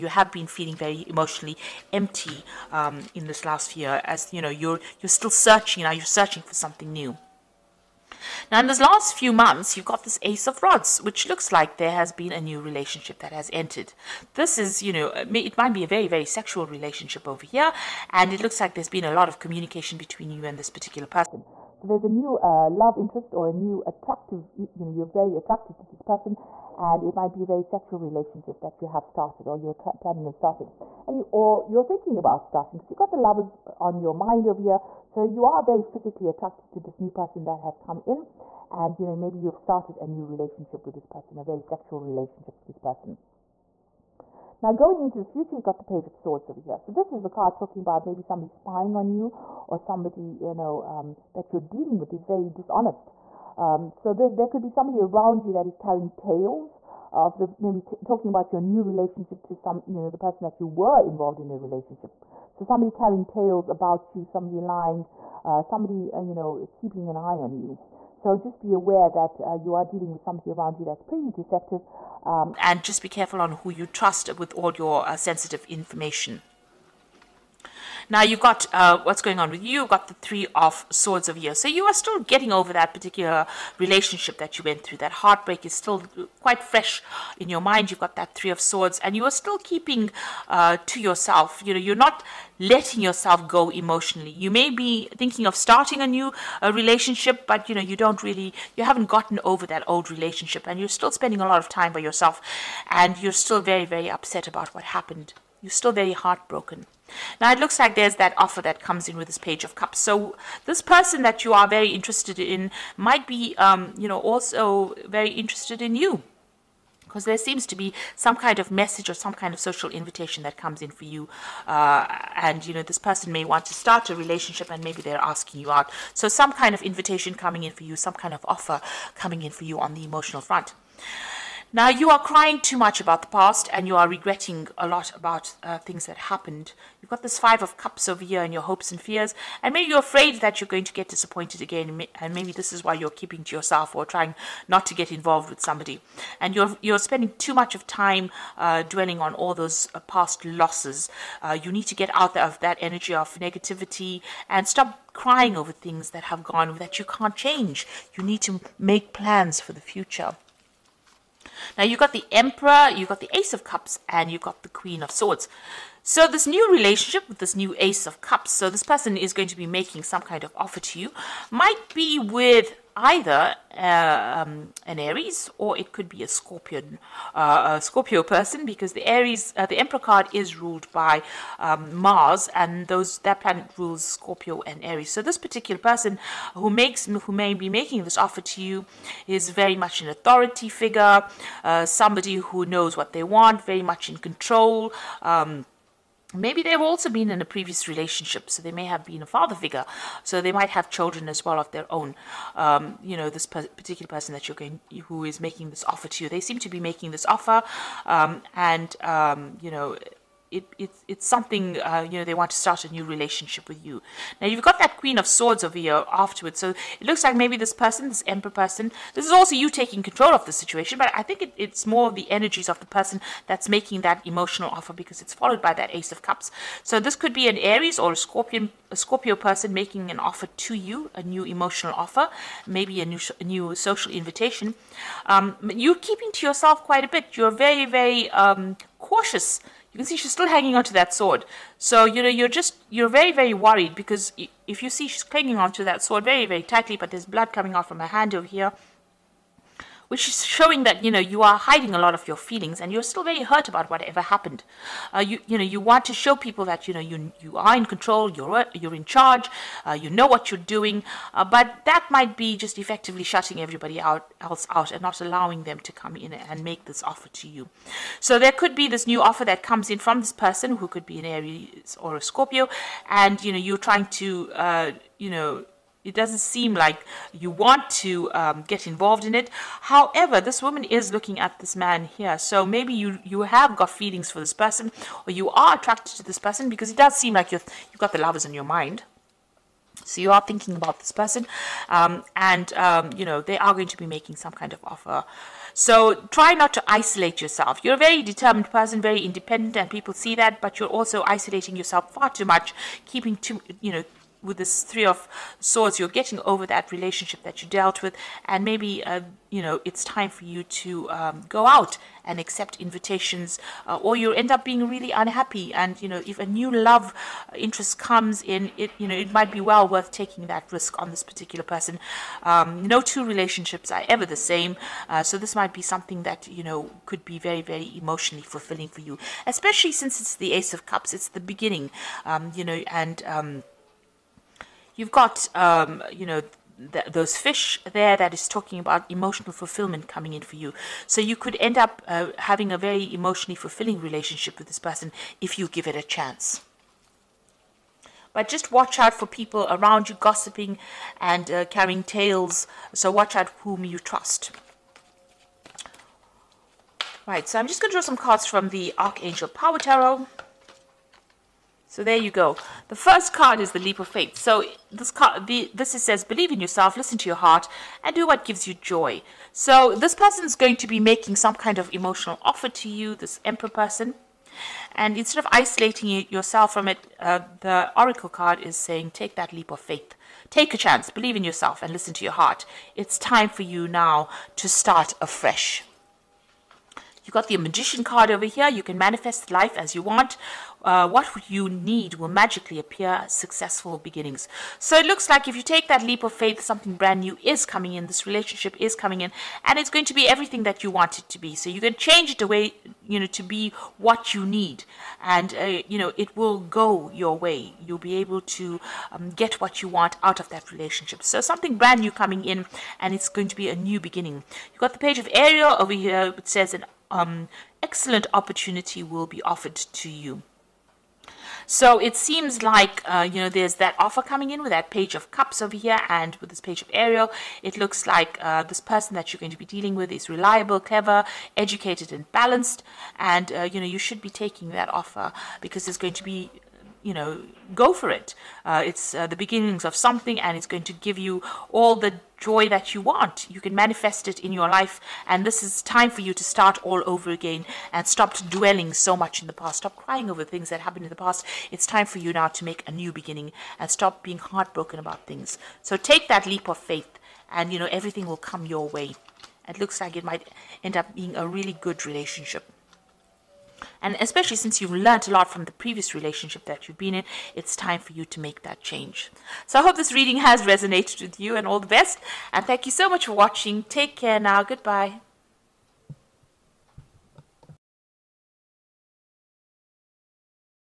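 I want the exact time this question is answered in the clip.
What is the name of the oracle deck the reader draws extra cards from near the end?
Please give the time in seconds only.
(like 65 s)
358 s.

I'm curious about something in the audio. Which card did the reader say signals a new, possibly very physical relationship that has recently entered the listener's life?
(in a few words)
Ace of Rods.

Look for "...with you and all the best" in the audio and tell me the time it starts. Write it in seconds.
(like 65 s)
471 s.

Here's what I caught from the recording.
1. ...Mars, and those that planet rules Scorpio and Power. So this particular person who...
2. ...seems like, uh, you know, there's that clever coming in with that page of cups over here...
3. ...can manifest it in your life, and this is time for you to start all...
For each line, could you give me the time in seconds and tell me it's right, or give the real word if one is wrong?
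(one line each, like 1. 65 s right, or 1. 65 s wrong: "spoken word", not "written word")
1. 181 s wrong: "Aries", not "Power"
2. 422 s wrong: "offer", not "clever"
3. 443 s right.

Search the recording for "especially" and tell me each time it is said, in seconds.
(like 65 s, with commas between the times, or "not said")
329 s, 464 s.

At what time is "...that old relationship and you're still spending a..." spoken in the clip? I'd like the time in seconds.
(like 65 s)
99 s.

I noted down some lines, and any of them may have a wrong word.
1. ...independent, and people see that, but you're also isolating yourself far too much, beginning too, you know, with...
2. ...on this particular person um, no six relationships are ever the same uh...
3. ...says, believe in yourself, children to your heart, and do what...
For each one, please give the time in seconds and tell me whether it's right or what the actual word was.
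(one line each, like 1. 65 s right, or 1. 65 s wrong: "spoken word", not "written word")
1. 299 s wrong: "keeping", not "beginning"
2. 321 s wrong: "two", not "six"
3. 366 s wrong: "listen", not "children".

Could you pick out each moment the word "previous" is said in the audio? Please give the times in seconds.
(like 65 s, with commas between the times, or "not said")
197 s, 465 s.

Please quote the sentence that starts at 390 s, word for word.
Uh, what you need will magically appear successful beginnings.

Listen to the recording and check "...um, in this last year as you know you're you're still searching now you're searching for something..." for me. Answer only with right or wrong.
right.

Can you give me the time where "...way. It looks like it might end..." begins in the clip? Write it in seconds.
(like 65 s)
458 s.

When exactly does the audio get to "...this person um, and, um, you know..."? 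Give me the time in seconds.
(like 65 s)
290 s.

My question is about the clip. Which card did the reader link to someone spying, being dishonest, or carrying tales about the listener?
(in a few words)
Page of Swords.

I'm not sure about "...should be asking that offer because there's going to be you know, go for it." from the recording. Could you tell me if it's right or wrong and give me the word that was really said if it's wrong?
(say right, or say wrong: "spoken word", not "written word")
wrong: "taking", not "asking".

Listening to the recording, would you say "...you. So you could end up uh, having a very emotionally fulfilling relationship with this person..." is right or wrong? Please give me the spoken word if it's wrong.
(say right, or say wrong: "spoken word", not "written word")
right.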